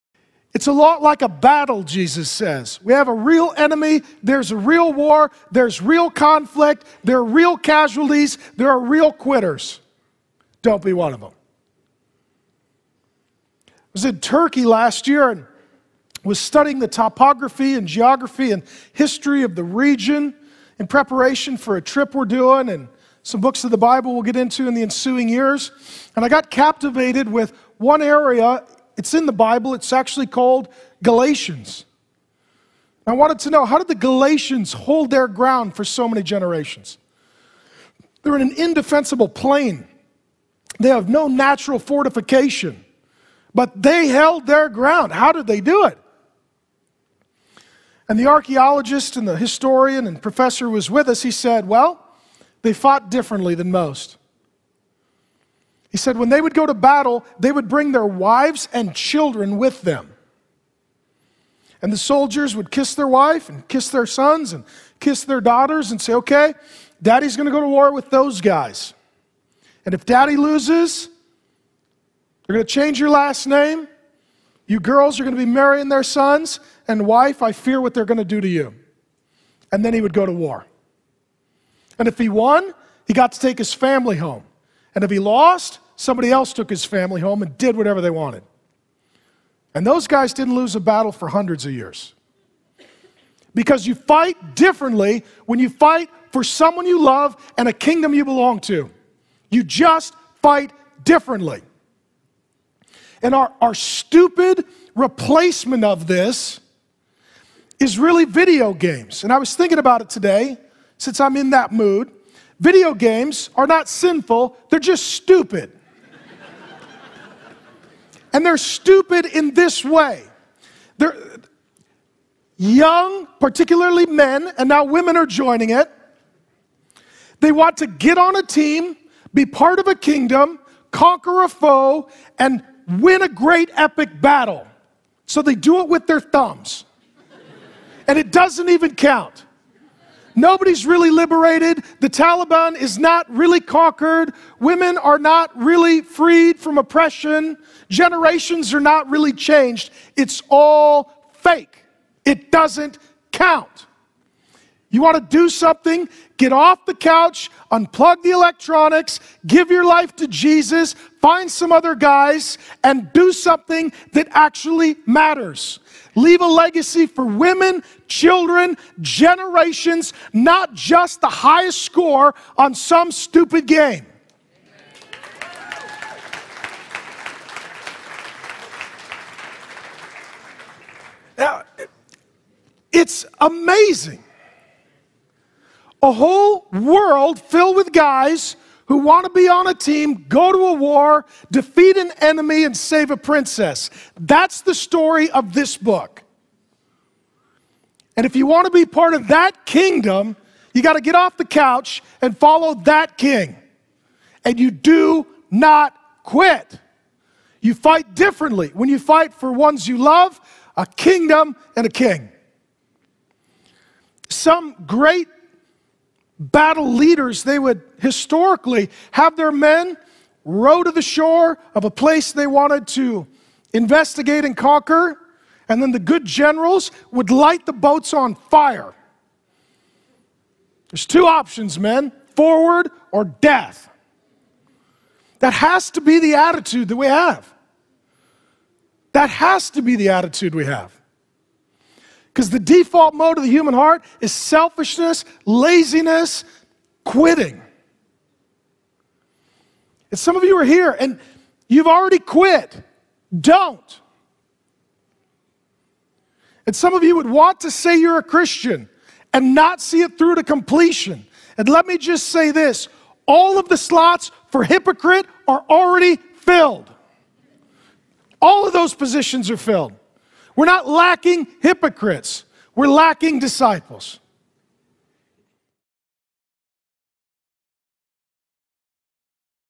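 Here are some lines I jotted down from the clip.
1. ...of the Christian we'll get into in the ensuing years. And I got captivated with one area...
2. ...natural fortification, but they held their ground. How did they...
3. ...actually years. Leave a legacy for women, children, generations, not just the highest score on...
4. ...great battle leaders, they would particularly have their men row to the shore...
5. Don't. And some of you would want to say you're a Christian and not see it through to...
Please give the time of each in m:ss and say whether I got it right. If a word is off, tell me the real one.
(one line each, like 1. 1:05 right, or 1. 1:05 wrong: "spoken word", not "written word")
1. 0:23 wrong: "Bible", not "Christian"
2. 0:41 right
3. 2:44 wrong: "matters", not "years"
4. 3:34 wrong: "historically", not "particularly"
5. 4:13 right.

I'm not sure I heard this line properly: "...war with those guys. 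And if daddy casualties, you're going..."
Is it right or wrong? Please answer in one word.
wrong.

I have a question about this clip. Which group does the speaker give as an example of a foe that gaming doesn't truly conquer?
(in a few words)
The Taliban.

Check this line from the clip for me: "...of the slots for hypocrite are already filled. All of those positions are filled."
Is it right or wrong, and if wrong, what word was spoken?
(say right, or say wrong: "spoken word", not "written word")
right.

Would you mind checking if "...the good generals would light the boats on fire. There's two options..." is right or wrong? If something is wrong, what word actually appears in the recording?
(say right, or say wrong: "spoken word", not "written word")
right.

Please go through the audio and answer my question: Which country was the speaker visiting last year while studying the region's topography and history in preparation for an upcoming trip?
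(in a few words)
Turkey.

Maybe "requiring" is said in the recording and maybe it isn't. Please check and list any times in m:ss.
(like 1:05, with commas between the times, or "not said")
not said.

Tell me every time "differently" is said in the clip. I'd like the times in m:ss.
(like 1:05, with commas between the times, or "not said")
0:53, 1:34, 1:41, 3:28.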